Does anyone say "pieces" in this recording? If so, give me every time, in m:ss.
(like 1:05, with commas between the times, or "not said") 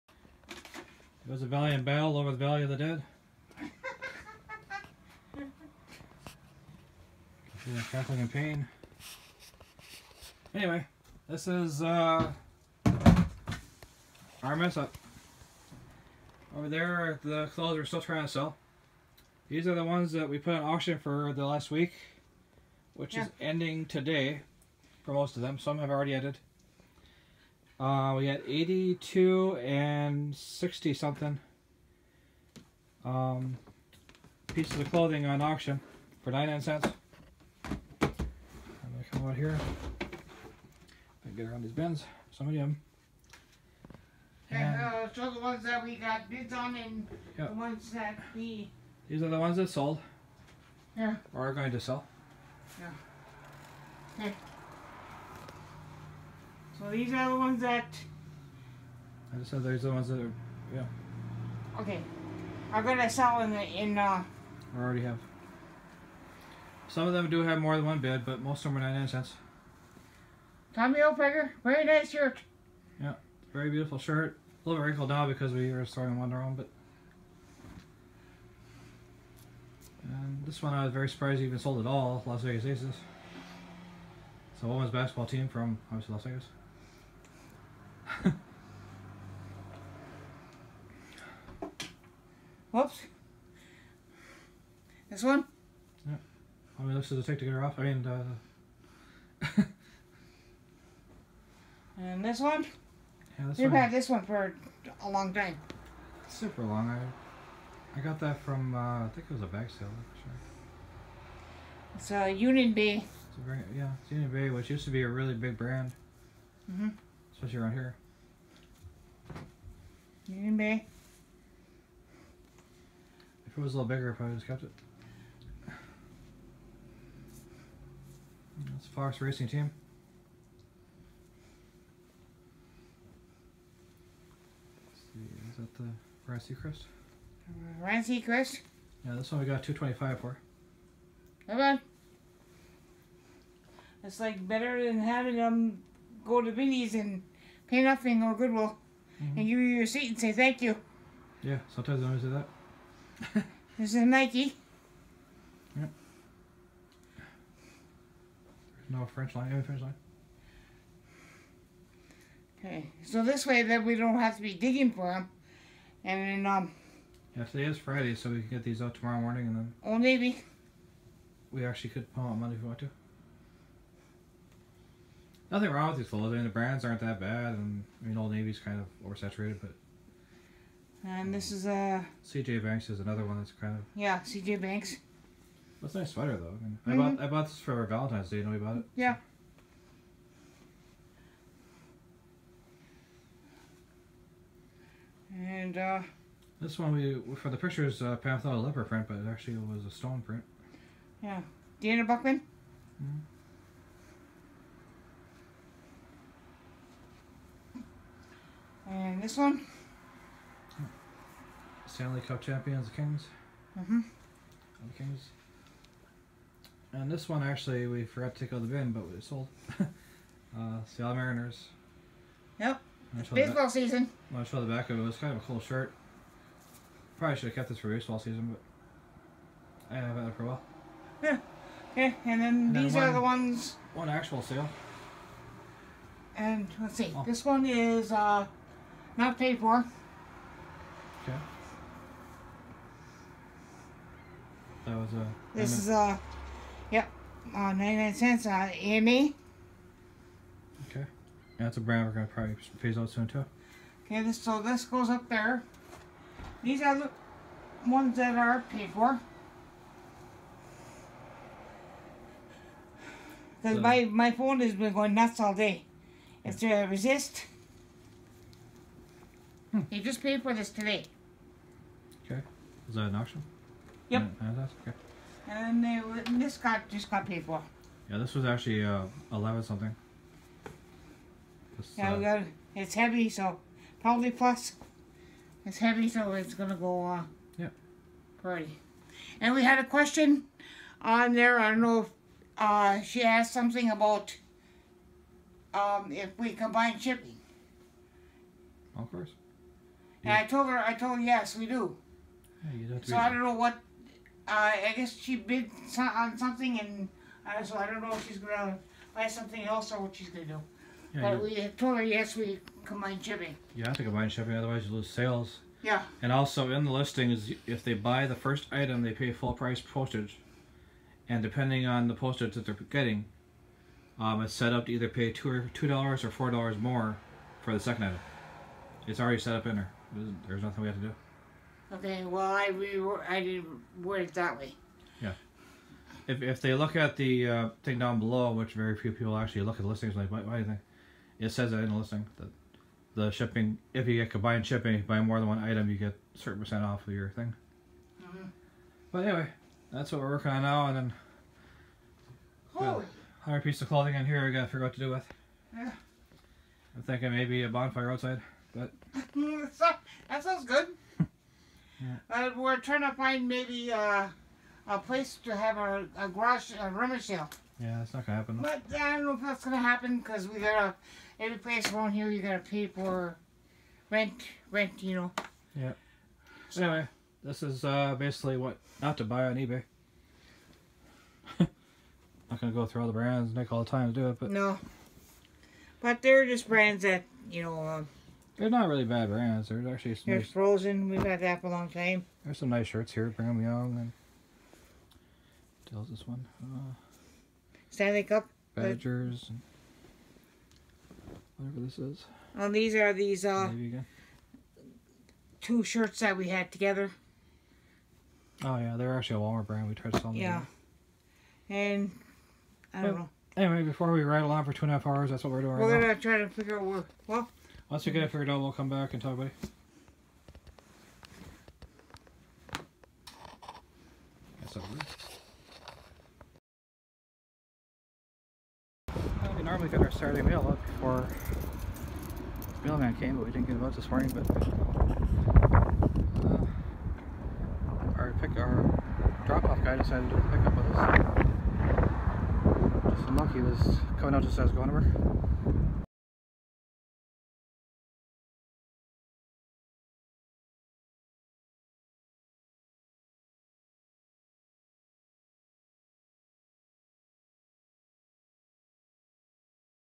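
0:34, 5:53.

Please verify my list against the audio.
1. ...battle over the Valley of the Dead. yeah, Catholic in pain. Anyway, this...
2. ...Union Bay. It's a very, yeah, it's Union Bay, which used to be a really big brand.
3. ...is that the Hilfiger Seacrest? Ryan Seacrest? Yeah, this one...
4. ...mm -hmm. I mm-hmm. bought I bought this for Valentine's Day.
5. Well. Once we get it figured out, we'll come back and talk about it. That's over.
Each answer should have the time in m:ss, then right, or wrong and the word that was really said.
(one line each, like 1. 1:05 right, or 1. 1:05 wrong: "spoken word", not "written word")
1. 0:01 right
2. 1:52 right
3. 2:15 wrong: "Ryan", not "Hilfiger"
4. 3:06 right
5. 6:57 right.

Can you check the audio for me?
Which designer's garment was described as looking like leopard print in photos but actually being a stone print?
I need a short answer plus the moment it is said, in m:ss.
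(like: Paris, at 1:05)
Dana Buchman, at 3:21.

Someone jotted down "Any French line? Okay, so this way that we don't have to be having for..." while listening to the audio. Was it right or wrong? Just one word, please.
wrong.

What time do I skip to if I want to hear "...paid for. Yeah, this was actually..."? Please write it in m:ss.
4:37.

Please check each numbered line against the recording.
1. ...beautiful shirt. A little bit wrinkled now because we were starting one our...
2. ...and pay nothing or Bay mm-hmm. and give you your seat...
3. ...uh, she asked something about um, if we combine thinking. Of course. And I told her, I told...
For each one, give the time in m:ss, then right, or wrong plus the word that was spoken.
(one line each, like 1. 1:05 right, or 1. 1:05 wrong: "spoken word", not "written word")
1. 1:13 right
2. 2:26 wrong: "Goodwill", not "Bay"
3. 4:52 wrong: "shipping", not "thinking".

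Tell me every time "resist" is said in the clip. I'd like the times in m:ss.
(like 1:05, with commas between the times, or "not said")
4:26.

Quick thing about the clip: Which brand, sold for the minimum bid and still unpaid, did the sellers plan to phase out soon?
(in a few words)
EME.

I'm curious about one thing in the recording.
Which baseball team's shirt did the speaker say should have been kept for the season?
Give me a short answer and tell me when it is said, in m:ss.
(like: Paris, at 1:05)
Seattle Mariners, at 3:40.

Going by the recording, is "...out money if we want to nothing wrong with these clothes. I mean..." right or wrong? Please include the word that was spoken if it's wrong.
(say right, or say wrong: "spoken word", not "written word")
right.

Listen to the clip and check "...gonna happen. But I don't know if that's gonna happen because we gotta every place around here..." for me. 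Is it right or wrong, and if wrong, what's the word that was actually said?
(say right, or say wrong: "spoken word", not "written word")
right.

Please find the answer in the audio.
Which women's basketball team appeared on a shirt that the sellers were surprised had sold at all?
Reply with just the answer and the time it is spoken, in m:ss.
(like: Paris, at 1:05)
Las Vegas Aces, at 1:22.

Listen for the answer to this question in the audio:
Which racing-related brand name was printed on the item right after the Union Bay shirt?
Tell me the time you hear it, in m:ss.
2:08.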